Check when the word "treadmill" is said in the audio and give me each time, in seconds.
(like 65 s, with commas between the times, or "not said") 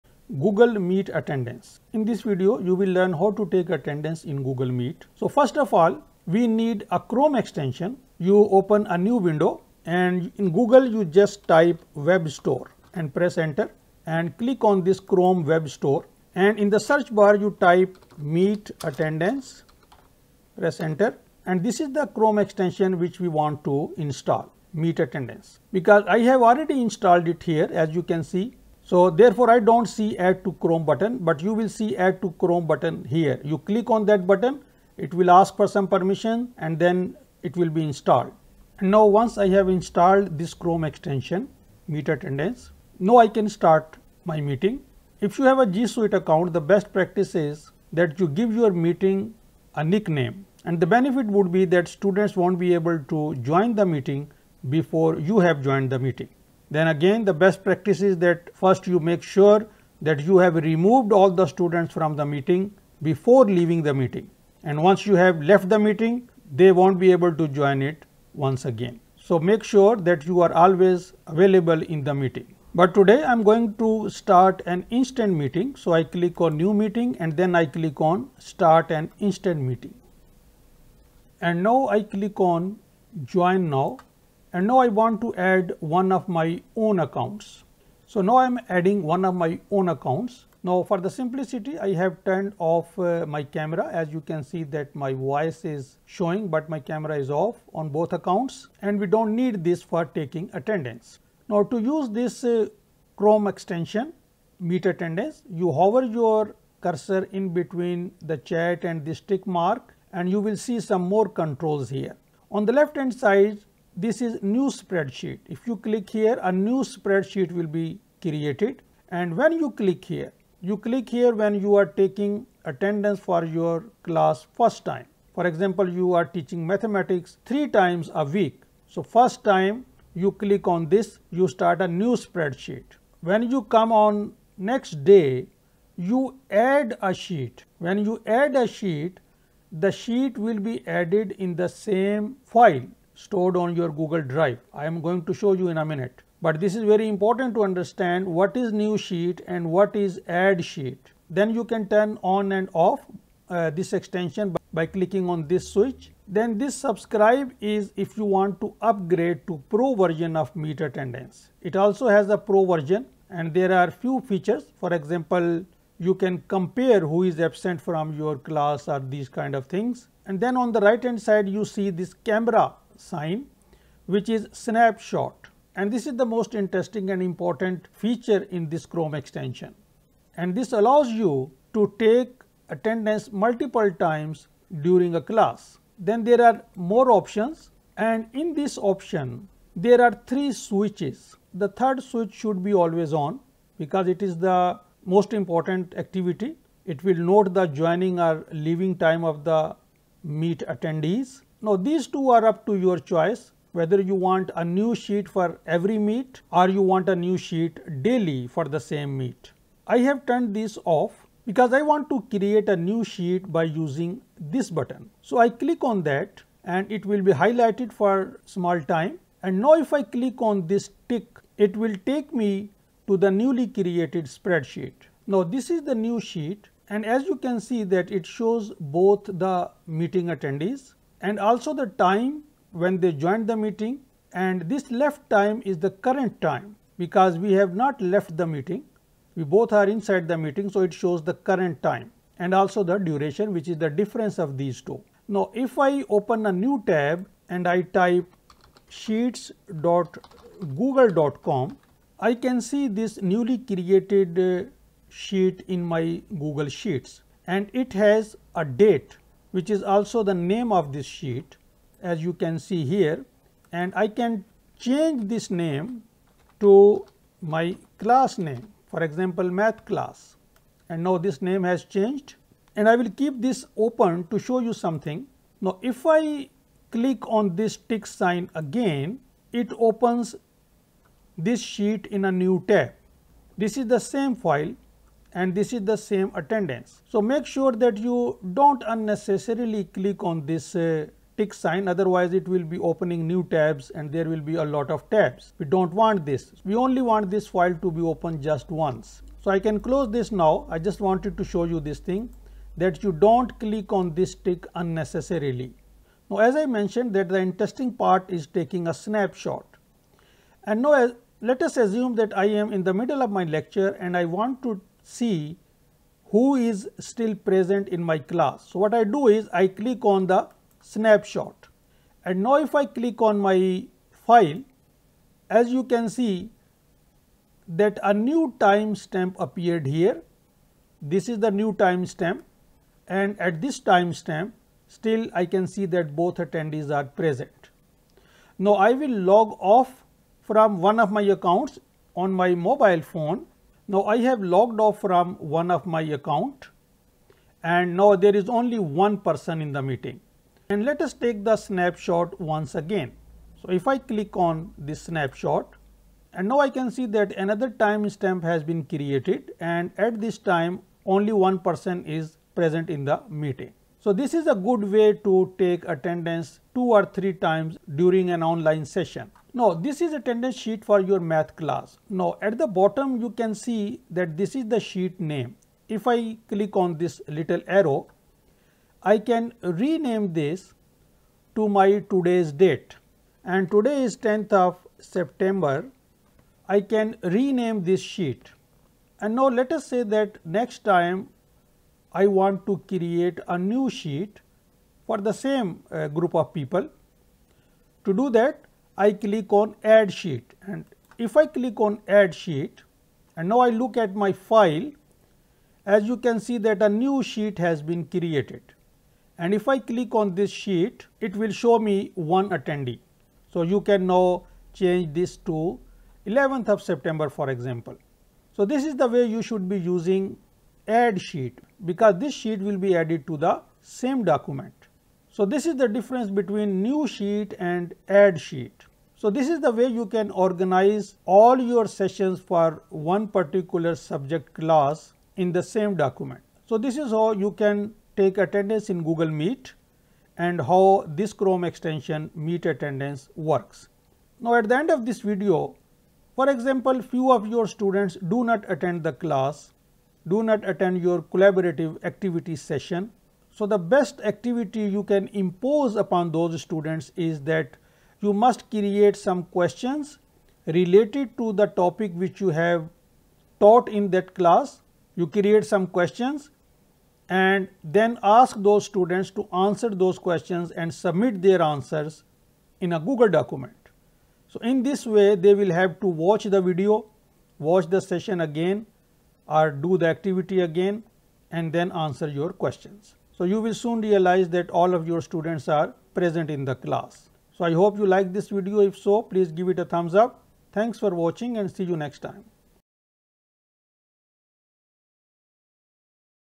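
not said.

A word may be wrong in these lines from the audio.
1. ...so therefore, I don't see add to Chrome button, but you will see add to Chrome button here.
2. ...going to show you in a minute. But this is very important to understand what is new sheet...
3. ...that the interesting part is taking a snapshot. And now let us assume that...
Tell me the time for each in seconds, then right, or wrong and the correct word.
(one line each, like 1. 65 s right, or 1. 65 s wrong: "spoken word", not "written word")
1. 28 s right
2. 145 s right
3. 307 s right.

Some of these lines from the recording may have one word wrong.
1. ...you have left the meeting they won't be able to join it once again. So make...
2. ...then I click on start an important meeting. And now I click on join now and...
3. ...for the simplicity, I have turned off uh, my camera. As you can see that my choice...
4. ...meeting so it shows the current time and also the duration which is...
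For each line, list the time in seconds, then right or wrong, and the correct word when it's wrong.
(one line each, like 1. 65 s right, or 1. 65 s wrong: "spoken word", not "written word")
1. 65 s right
2. 77 s wrong: "instant", not "important"
3. 90 s wrong: "voice", not "choice"
4. 240 s right.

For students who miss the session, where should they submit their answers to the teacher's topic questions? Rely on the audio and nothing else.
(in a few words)
a Google document.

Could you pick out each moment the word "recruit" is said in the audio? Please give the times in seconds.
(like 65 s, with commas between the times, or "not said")
not said.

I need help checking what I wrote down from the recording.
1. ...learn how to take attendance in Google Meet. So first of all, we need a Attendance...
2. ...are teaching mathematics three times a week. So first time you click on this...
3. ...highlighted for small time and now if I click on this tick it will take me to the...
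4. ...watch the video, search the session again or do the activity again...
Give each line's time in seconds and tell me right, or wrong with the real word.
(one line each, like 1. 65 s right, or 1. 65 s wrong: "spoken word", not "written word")
1. 2 s wrong: "Chrome", not "Attendance"
2. 126 s right
3. 217 s right
4. 476 s wrong: "watch", not "search".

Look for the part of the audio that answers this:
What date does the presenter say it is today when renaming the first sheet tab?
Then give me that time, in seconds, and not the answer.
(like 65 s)
384 s.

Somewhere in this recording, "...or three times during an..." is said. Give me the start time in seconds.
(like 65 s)
366 s.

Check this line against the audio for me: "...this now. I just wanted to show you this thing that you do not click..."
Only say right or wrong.
right.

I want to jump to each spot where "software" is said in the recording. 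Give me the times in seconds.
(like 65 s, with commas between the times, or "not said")
not said.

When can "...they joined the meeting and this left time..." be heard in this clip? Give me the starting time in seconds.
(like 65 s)
232 s.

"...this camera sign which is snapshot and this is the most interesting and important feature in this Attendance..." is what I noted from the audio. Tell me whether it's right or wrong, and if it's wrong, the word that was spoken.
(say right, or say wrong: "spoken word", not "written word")
wrong: "Chrome", not "Attendance".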